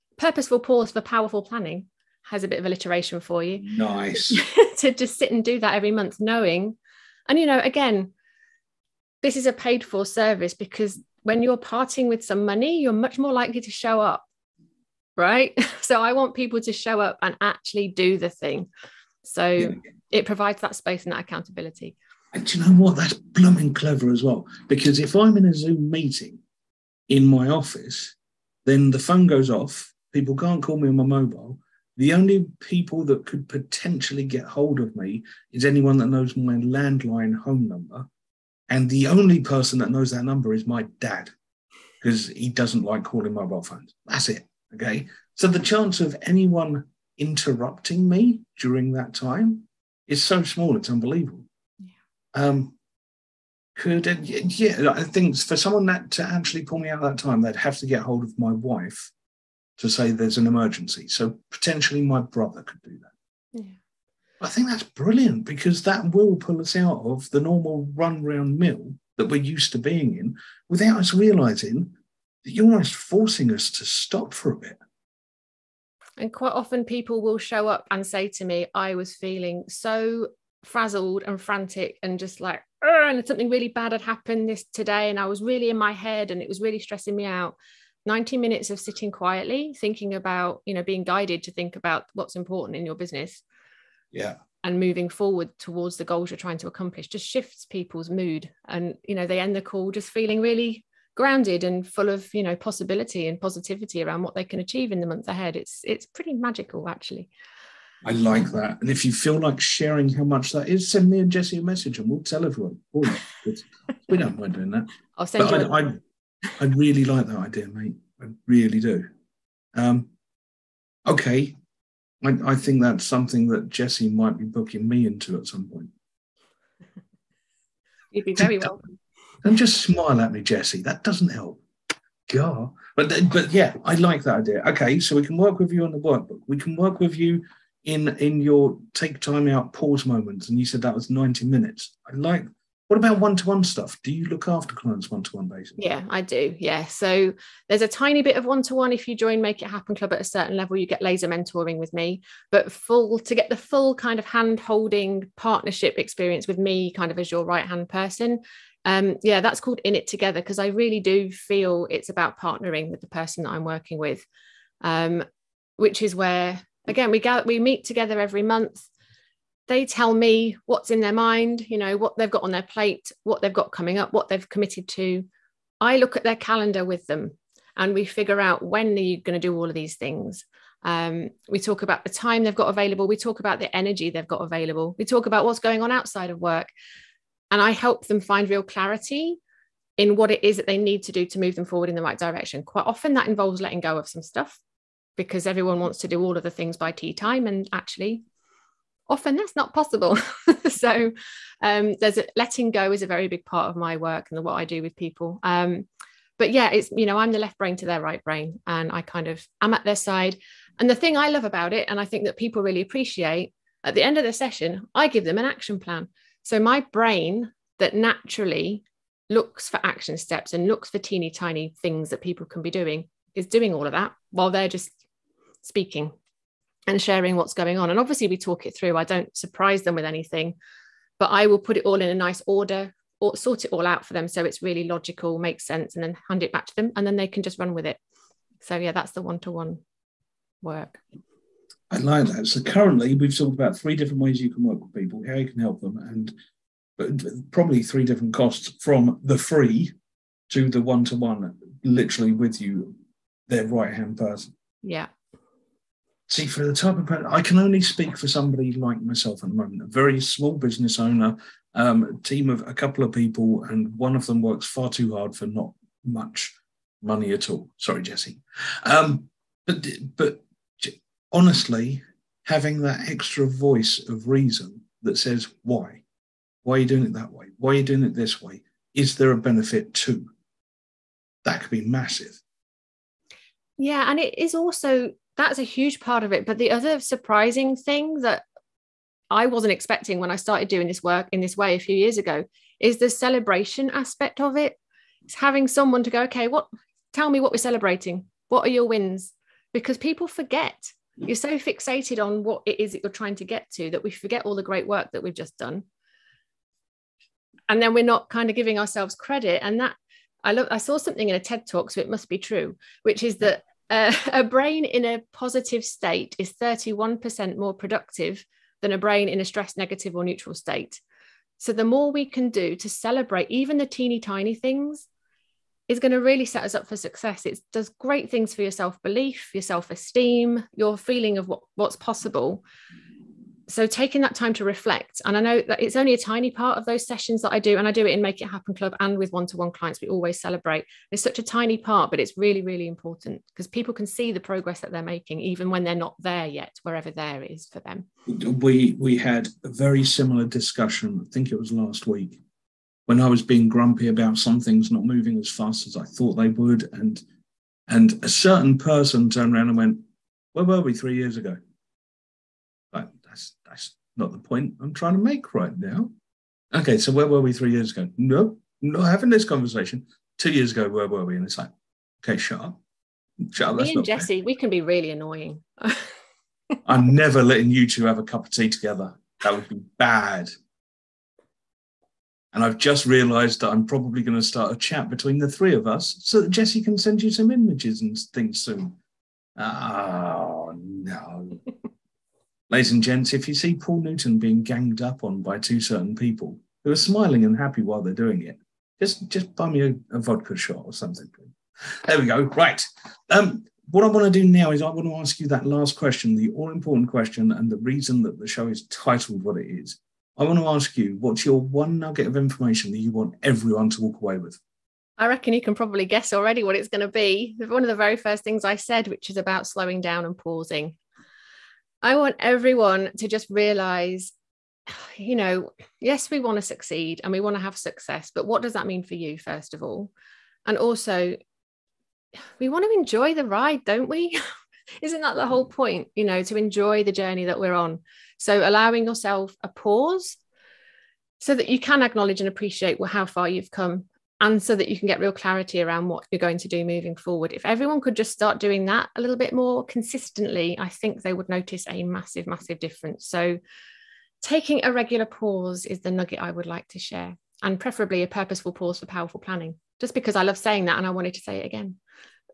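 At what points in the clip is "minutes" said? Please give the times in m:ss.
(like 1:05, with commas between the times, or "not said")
1:28, 2:21.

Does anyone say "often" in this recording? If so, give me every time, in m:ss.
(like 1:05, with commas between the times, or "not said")
1:16, 3:12, 3:19.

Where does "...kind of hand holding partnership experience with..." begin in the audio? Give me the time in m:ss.
2:33.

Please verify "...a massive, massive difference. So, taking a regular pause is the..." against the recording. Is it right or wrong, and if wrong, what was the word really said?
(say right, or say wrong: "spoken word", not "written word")
right.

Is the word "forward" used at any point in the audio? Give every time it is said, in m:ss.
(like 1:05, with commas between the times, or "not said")
1:35, 3:11, 7:27.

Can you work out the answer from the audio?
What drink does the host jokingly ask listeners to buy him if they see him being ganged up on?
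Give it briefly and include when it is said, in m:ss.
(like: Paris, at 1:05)
A vodka shot, at 6:40.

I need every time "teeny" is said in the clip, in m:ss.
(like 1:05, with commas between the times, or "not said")
3:40, 5:23.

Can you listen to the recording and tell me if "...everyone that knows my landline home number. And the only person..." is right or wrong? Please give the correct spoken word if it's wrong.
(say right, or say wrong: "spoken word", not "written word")
wrong: "anyone", not "everyone".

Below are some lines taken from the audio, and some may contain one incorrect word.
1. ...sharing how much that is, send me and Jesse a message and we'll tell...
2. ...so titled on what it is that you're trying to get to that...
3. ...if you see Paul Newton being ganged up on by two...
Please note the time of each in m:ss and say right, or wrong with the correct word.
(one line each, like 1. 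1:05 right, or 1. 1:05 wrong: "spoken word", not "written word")
1. 1:49 right
2. 5:01 wrong: "fixated", not "titled"
3. 6:33 right.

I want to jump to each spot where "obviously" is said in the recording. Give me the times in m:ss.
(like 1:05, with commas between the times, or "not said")
3:47.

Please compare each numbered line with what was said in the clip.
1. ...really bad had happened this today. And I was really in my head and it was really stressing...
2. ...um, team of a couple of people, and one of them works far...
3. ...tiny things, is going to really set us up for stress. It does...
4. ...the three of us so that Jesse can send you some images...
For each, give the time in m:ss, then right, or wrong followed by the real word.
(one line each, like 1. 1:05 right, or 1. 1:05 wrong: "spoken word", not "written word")
1. 1:23 right
2. 4:21 right
3. 5:24 wrong: "success", not "stress"
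4. 6:25 right.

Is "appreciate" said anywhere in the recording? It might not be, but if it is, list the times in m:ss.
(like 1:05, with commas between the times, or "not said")
3:32, 7:22.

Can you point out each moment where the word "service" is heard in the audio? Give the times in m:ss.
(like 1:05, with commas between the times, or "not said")
0:10.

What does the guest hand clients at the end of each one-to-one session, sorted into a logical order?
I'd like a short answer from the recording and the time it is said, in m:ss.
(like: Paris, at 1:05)
An action plan, at 3:35.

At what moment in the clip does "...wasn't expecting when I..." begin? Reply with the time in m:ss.
4:49.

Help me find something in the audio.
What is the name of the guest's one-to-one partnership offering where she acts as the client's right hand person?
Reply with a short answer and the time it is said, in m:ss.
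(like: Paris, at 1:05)
In It Together, at 2:39.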